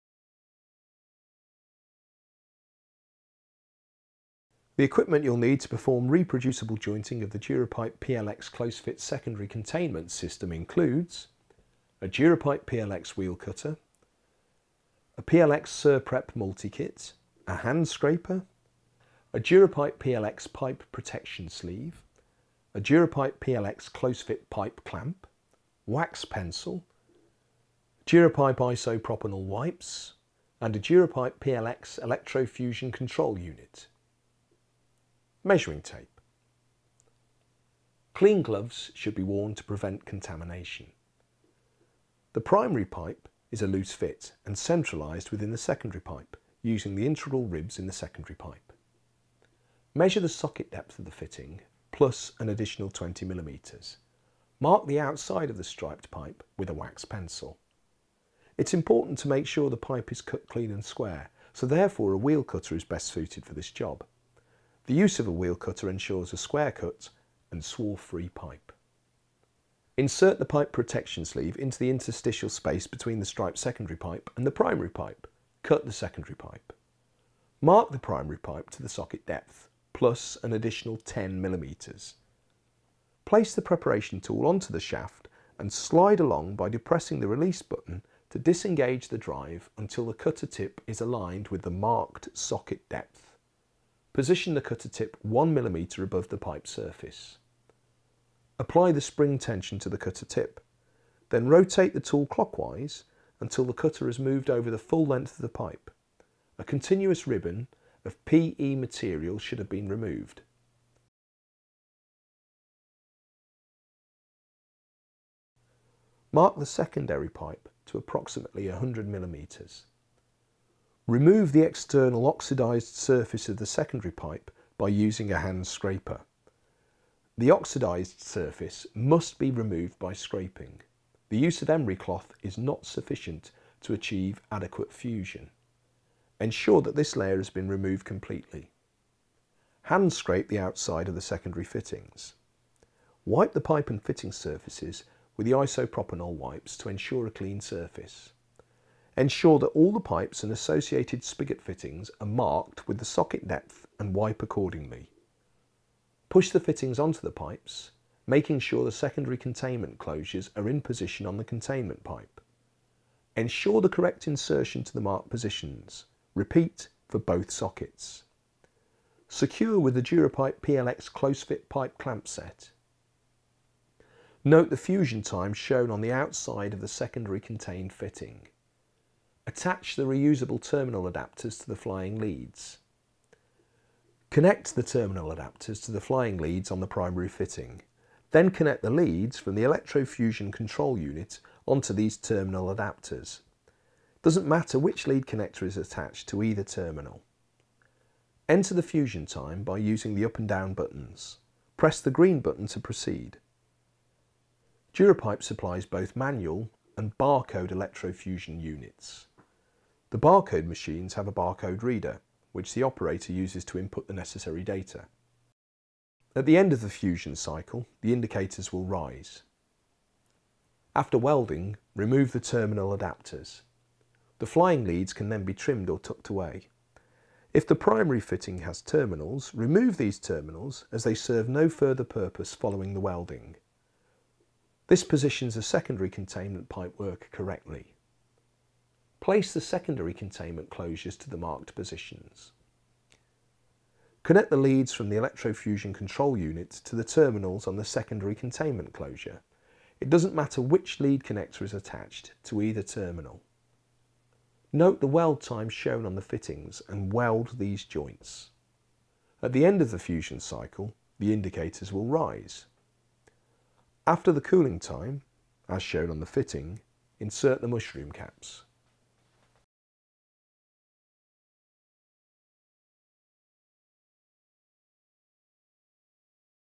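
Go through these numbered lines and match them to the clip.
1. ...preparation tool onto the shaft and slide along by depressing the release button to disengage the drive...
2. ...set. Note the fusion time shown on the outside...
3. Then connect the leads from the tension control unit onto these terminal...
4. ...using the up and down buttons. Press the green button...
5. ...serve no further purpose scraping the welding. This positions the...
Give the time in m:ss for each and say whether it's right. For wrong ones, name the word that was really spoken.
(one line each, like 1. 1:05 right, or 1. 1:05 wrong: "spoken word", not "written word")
1. 1:23 right
2. 2:52 right
3. 3:08 wrong: "electrofusion", not "tension"
4. 3:19 right
5. 3:51 wrong: "following", not "scraping".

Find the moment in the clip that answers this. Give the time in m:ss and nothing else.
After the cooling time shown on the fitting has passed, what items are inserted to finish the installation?
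4:27.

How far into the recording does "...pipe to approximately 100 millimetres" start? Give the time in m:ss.
1:57.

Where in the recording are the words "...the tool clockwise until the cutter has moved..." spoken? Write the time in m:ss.
1:41.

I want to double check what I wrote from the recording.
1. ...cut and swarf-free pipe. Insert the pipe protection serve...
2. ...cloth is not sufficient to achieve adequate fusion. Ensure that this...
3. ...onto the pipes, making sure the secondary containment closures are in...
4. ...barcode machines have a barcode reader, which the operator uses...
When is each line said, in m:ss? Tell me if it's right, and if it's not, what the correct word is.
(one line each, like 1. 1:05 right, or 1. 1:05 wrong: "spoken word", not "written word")
1. 1:06 wrong: "sleeve", not "serve"
2. 2:11 right
3. 2:36 right
4. 3:30 right.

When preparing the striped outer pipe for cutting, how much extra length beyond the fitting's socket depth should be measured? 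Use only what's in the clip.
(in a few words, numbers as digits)
20 millimetres.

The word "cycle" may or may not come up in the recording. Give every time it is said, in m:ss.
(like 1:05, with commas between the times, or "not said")
3:37, 4:20.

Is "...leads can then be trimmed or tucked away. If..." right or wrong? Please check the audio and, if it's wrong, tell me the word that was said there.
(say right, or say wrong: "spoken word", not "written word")
right.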